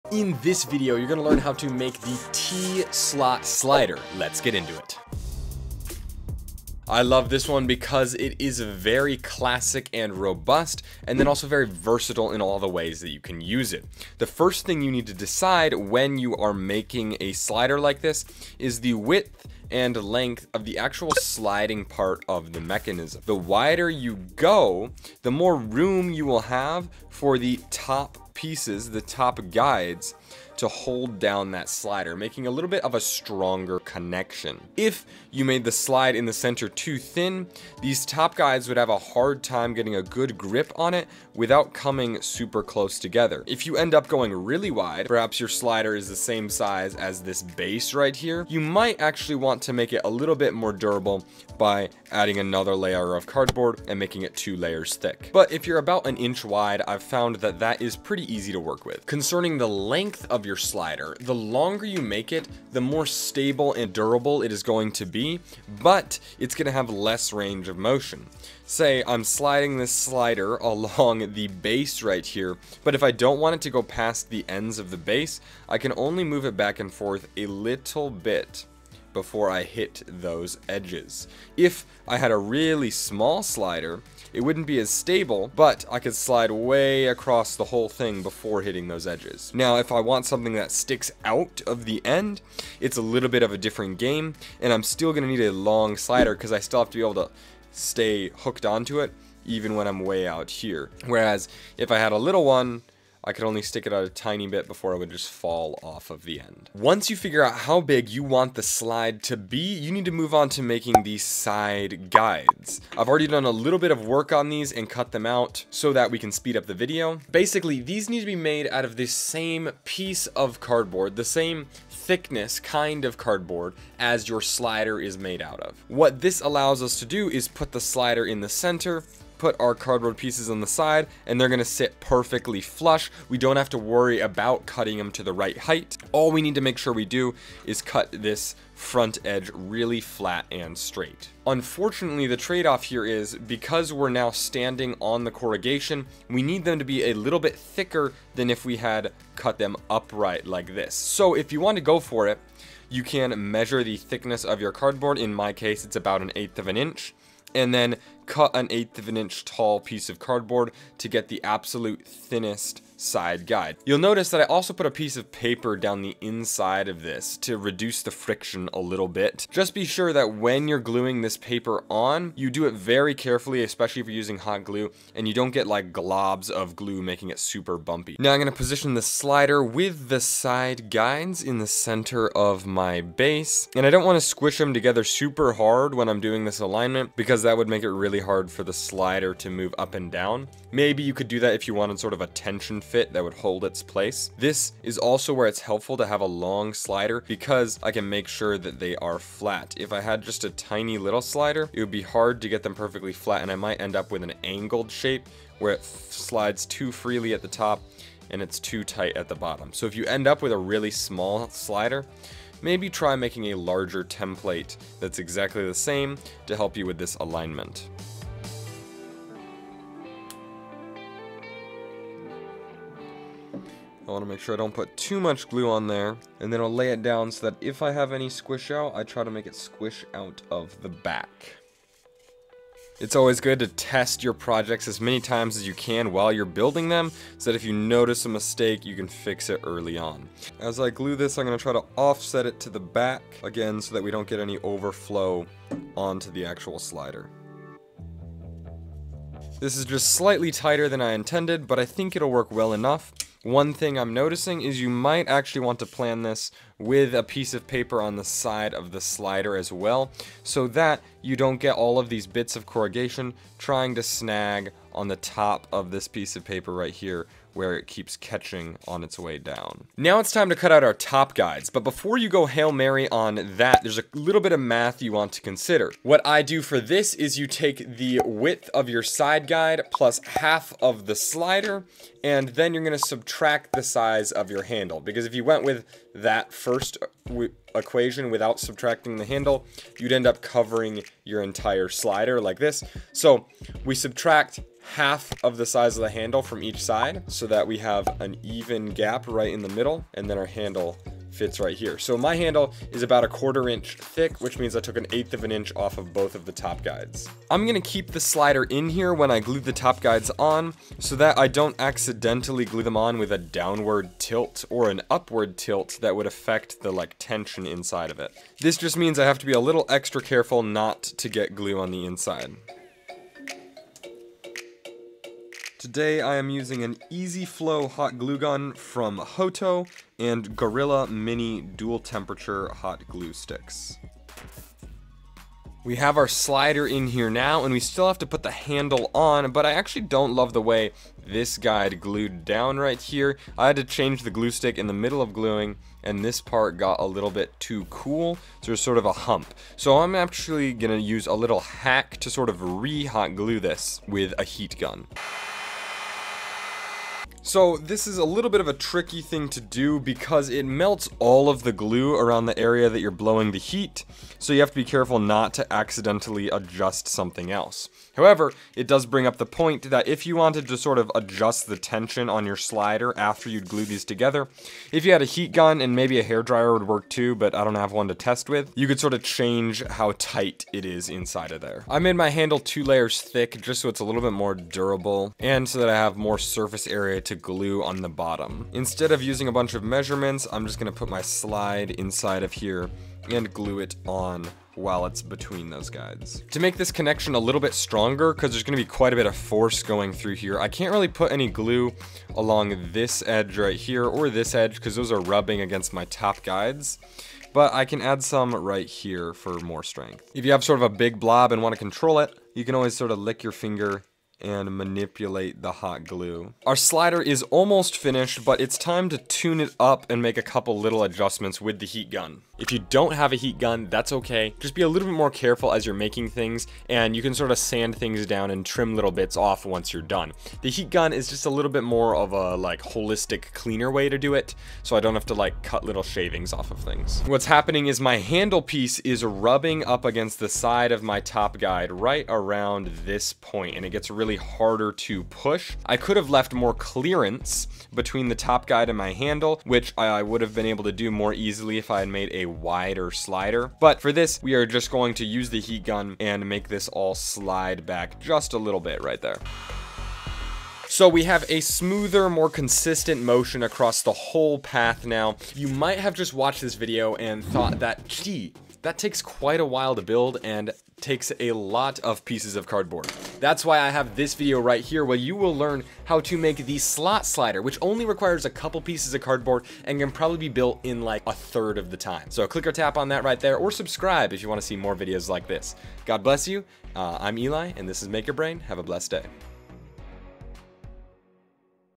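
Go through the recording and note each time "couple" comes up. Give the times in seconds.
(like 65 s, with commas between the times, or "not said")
420 s, 478 s.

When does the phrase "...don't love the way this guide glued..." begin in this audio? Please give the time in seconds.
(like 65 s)
340 s.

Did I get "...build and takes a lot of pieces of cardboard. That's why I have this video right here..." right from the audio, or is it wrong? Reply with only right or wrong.
right.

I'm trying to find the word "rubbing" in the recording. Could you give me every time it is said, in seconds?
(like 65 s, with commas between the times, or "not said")
405 s, 439 s.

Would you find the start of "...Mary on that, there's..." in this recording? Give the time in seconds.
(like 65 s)
272 s.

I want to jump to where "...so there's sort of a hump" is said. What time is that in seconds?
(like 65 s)
348 s.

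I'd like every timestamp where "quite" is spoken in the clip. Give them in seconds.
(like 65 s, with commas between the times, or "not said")
398 s, 469 s.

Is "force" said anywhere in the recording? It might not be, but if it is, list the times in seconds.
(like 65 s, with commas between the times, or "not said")
399 s.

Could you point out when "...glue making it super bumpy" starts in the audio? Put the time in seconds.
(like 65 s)
176 s.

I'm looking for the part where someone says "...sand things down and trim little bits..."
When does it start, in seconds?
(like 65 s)
427 s.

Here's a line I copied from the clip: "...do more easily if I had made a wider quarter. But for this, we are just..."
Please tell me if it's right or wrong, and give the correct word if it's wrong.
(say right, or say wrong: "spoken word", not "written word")
wrong: "slider", not "quarter".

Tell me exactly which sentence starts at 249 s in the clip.
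This is just slightly tighter than I intended, but I think it'll work well enough.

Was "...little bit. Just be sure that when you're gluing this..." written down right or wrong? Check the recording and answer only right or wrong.
right.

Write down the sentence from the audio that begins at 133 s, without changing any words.
We don't have to worry about cutting them to the right height.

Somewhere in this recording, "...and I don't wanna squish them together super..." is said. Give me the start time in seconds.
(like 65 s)
183 s.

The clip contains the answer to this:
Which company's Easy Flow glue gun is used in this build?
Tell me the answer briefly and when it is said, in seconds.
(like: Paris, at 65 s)
Hoto, at 329 s.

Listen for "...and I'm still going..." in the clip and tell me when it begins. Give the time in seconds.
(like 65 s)
94 s.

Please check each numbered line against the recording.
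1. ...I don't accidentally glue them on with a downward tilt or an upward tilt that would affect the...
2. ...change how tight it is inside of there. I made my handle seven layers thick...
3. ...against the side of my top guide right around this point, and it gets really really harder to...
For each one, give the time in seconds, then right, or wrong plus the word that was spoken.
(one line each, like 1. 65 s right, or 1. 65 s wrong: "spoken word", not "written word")
1. 311 s right
2. 379 s wrong: "two", not "seven"
3. 440 s right.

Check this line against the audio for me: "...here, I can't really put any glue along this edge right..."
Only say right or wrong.
right.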